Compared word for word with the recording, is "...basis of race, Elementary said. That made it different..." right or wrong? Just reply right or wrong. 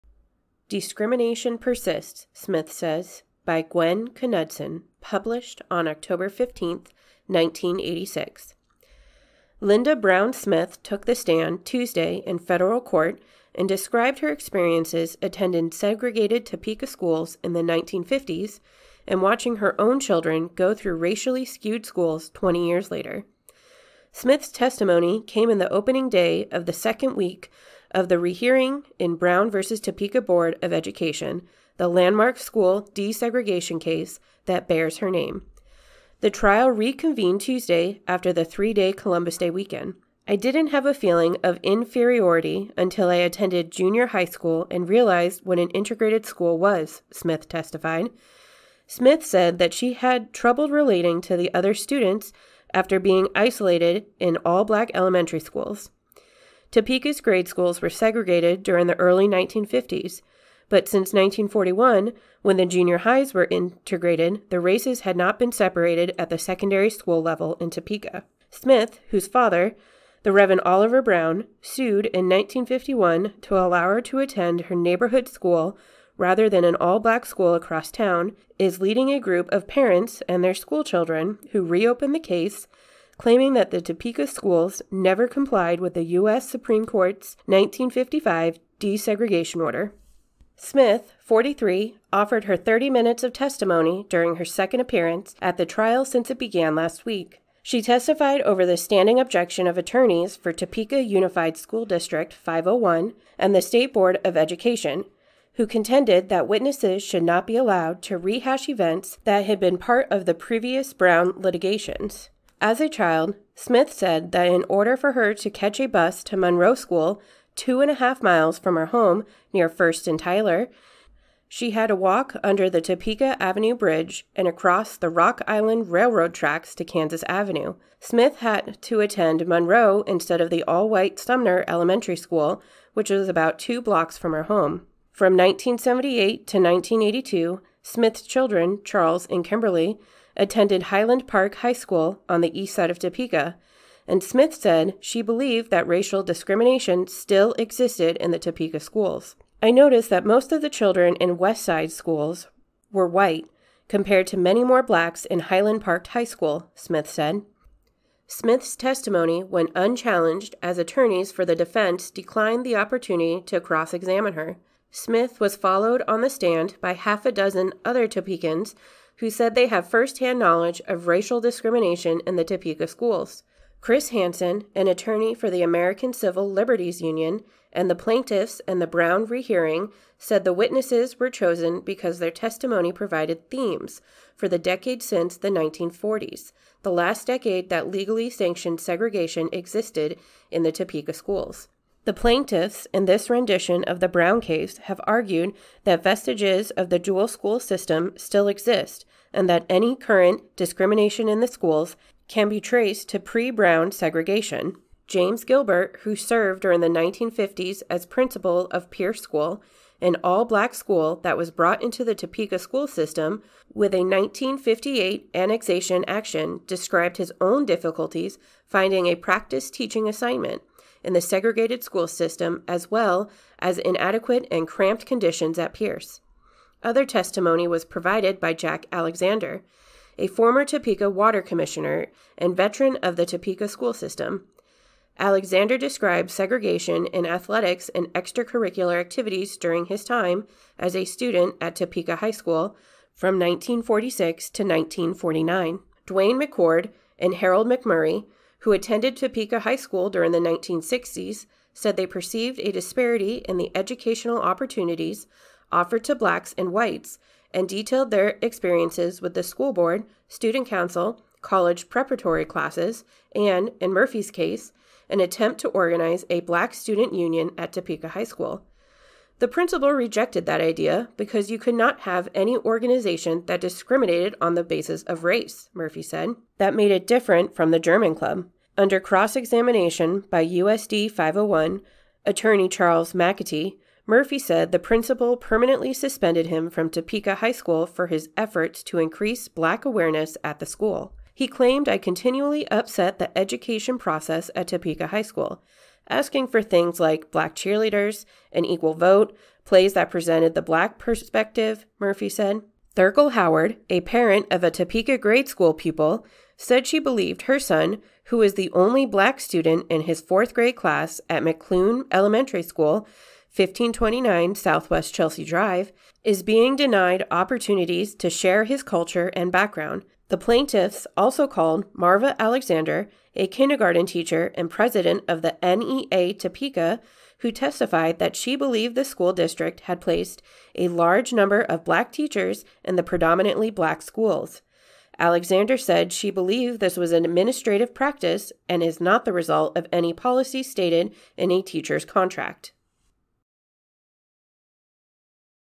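wrong.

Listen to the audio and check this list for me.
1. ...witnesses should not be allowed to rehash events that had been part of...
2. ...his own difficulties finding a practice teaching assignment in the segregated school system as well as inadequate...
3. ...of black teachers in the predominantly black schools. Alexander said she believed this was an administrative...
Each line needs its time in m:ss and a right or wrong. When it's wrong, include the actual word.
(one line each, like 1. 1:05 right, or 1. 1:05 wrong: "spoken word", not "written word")
1. 1:46 right
2. 3:37 right
3. 5:31 right.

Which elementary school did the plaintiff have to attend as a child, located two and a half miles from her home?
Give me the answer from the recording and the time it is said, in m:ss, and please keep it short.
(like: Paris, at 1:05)
Monroe School, at 1:56.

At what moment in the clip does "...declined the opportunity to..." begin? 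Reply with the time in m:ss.
2:42.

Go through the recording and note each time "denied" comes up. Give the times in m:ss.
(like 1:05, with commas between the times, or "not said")
5:16.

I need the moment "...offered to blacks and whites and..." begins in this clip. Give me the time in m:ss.
4:15.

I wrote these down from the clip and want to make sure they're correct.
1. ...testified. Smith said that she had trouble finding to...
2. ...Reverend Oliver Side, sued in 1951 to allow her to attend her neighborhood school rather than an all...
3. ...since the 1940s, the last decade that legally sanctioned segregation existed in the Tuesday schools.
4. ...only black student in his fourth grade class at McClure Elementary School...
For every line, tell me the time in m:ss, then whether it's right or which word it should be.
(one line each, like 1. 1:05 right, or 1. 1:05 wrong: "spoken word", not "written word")
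1. 0:47 wrong: "relating", not "finding"
2. 1:10 wrong: "Brown", not "Side"
3. 3:05 wrong: "Topeka", not "Tuesday"
4. 5:08 right.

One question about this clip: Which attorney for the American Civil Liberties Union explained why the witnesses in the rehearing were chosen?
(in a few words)
Chris Hansen.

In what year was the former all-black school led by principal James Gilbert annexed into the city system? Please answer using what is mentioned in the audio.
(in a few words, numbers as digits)
1958.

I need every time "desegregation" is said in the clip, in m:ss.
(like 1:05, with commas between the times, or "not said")
0:32, 1:28.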